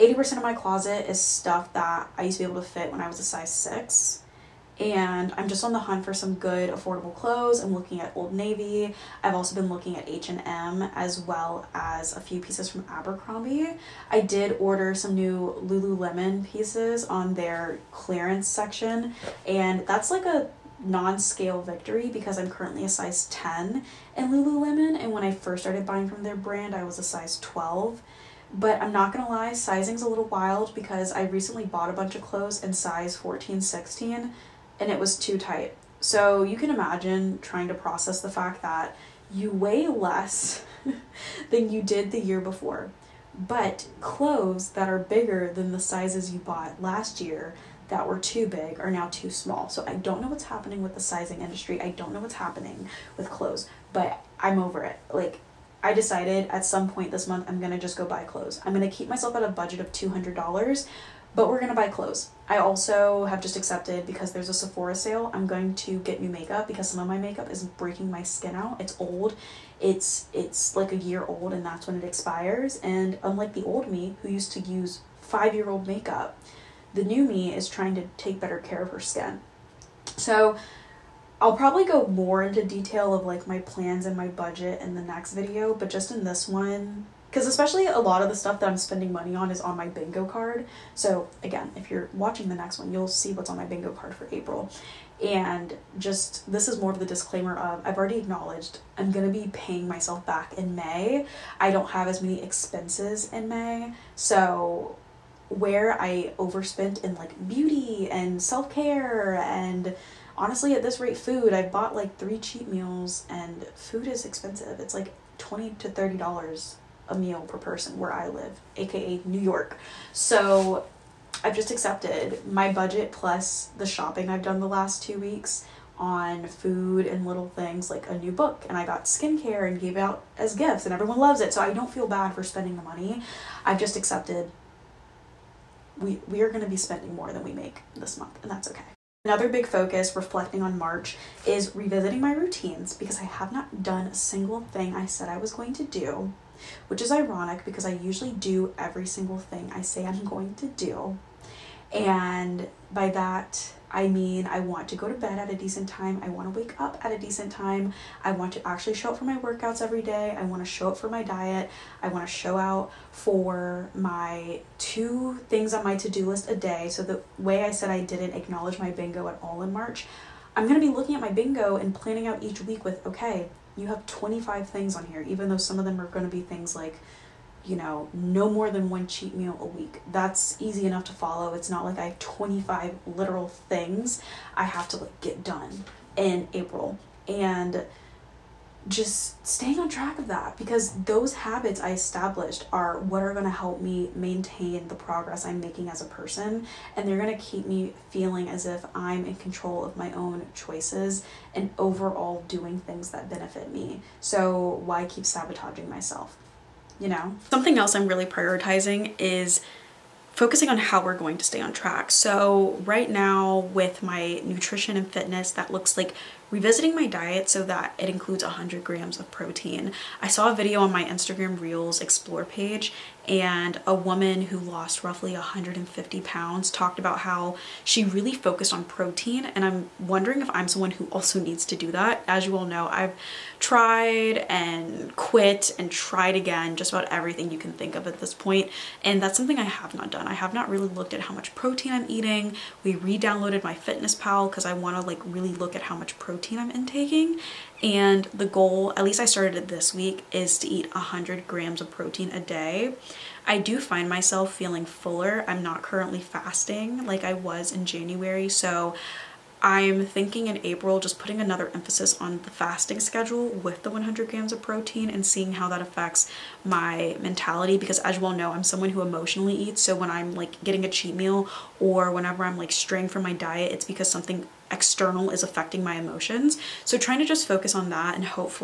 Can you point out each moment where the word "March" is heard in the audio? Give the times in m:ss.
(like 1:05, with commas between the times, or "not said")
2:20, 2:49.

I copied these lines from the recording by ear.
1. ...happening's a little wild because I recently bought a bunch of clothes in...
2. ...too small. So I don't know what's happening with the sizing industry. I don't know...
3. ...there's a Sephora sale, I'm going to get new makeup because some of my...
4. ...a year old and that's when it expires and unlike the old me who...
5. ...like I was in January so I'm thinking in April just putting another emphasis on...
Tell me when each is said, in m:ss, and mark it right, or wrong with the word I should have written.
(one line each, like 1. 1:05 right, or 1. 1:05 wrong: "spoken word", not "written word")
1. 0:29 wrong: "sizing", not "happening"
2. 0:49 right
3. 1:04 right
4. 1:10 right
5. 4:17 right.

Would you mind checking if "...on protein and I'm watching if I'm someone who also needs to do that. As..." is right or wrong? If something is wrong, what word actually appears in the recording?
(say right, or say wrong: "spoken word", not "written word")
wrong: "wondering", not "watching".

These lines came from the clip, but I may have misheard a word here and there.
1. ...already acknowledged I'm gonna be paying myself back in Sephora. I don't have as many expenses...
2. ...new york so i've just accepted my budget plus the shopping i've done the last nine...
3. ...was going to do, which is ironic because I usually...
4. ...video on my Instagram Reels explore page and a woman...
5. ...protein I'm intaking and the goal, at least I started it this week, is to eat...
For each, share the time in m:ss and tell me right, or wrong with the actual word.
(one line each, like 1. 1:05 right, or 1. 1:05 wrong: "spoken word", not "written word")
1. 1:37 wrong: "May", not "Sephora"
2. 1:59 wrong: "two", not "nine"
3. 2:25 right
4. 3:40 right
5. 4:06 right.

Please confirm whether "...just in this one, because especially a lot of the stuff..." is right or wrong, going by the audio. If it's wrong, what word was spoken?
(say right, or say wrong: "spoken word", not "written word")
right.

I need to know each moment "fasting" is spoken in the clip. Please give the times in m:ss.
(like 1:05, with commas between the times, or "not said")
4:16, 4:22.